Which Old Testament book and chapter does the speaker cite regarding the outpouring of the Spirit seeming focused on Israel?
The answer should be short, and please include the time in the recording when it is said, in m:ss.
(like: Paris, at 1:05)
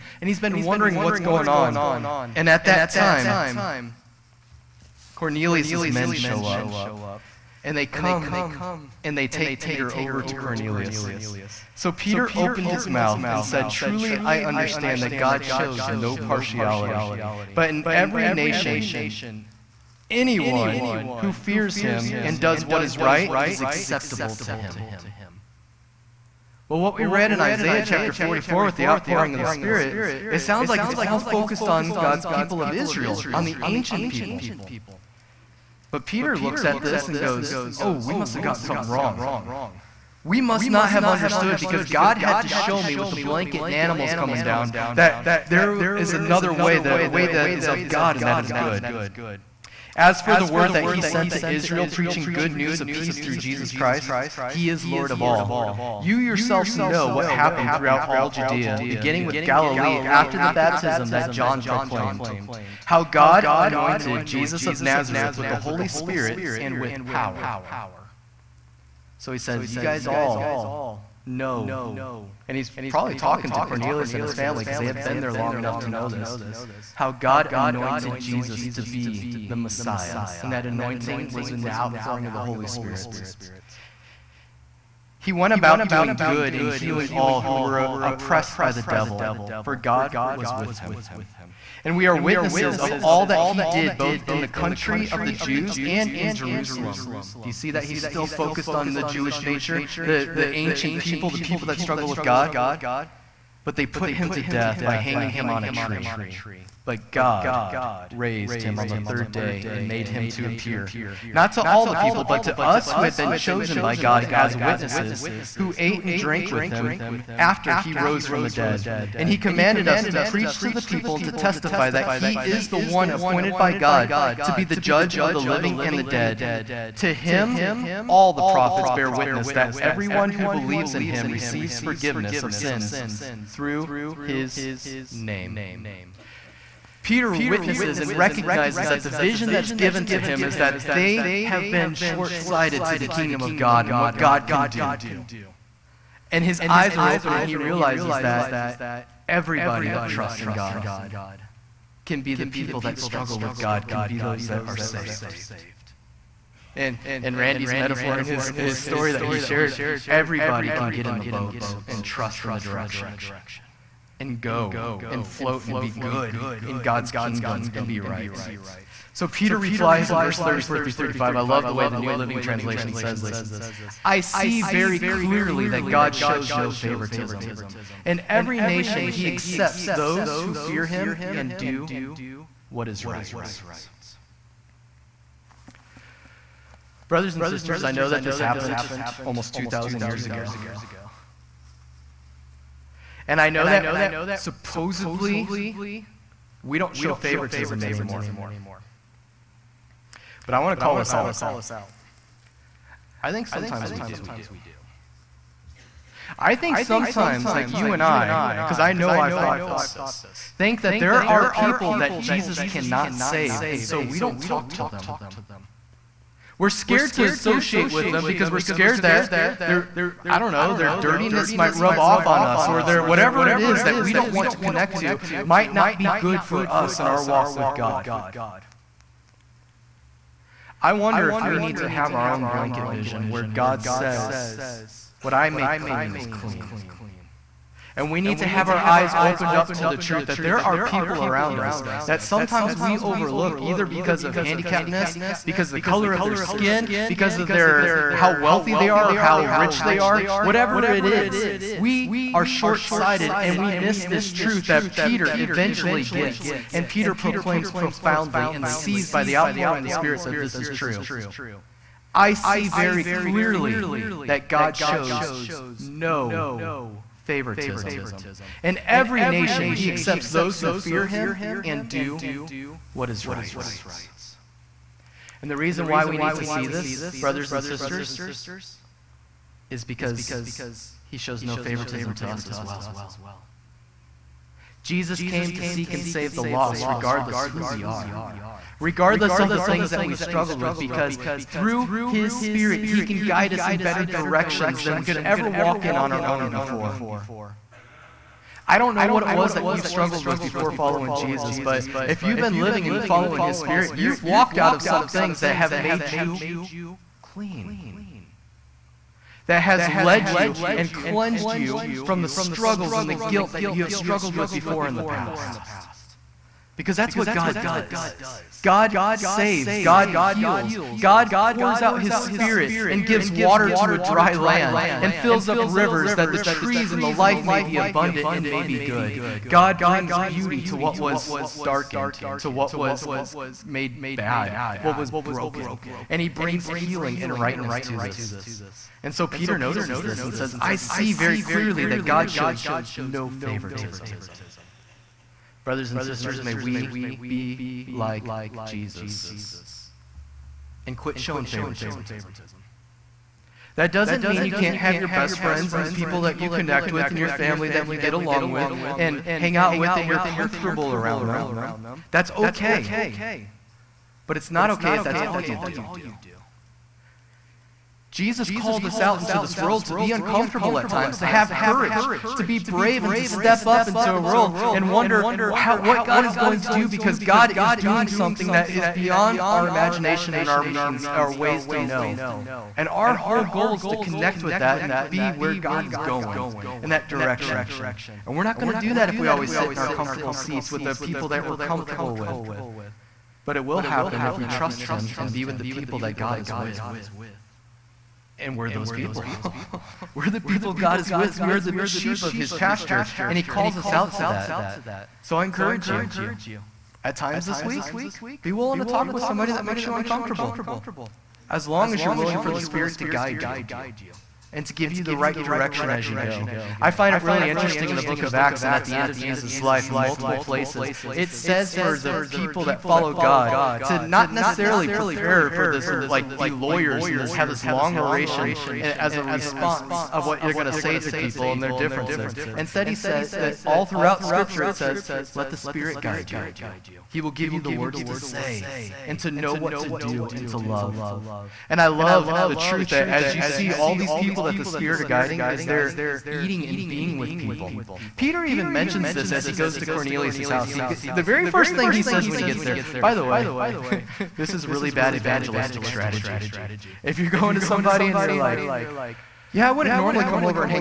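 Isaiah 44, at 0:27.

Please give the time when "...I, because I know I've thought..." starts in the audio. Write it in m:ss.
3:28.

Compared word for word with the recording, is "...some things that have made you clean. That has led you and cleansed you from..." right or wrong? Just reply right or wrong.
right.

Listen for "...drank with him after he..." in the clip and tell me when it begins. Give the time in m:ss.
1:56.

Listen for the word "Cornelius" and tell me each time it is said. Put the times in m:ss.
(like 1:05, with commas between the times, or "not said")
0:05, 0:10, 1:13, 7:29.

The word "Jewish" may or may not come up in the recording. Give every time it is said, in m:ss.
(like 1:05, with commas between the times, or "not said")
1:39.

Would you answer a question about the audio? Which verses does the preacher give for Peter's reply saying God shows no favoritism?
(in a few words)
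34 through 35.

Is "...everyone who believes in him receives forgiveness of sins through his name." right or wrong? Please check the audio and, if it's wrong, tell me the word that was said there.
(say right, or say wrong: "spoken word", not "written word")
right.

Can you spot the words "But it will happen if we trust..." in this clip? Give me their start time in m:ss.
6:33.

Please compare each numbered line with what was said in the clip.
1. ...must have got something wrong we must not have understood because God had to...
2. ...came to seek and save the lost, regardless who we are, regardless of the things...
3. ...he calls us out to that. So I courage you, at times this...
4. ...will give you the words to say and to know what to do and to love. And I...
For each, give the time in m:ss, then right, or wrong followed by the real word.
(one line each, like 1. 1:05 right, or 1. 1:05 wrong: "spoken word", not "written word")
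1. 0:38 right
2. 4:45 right
3. 6:43 wrong: "encourage", not "courage"
4. 7:17 right.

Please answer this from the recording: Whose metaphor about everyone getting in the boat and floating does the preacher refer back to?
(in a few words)
Randy.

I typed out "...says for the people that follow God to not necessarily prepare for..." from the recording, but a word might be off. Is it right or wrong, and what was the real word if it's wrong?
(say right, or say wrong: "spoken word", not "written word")
right.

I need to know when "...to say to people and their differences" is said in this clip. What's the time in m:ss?
7:10.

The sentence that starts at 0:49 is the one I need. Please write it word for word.
As for the word that he sent to Israel, preaching good news of peace through Jesus Christ, he is Lord of all.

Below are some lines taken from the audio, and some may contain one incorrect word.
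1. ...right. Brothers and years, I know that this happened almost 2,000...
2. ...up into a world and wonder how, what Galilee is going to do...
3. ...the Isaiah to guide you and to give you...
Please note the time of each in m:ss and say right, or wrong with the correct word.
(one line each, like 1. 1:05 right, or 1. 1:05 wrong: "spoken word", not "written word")
1. 3:03 wrong: "sisters", not "years"
2. 6:13 wrong: "God", not "Galilee"
3. 6:52 wrong: "Spirit", not "Isaiah".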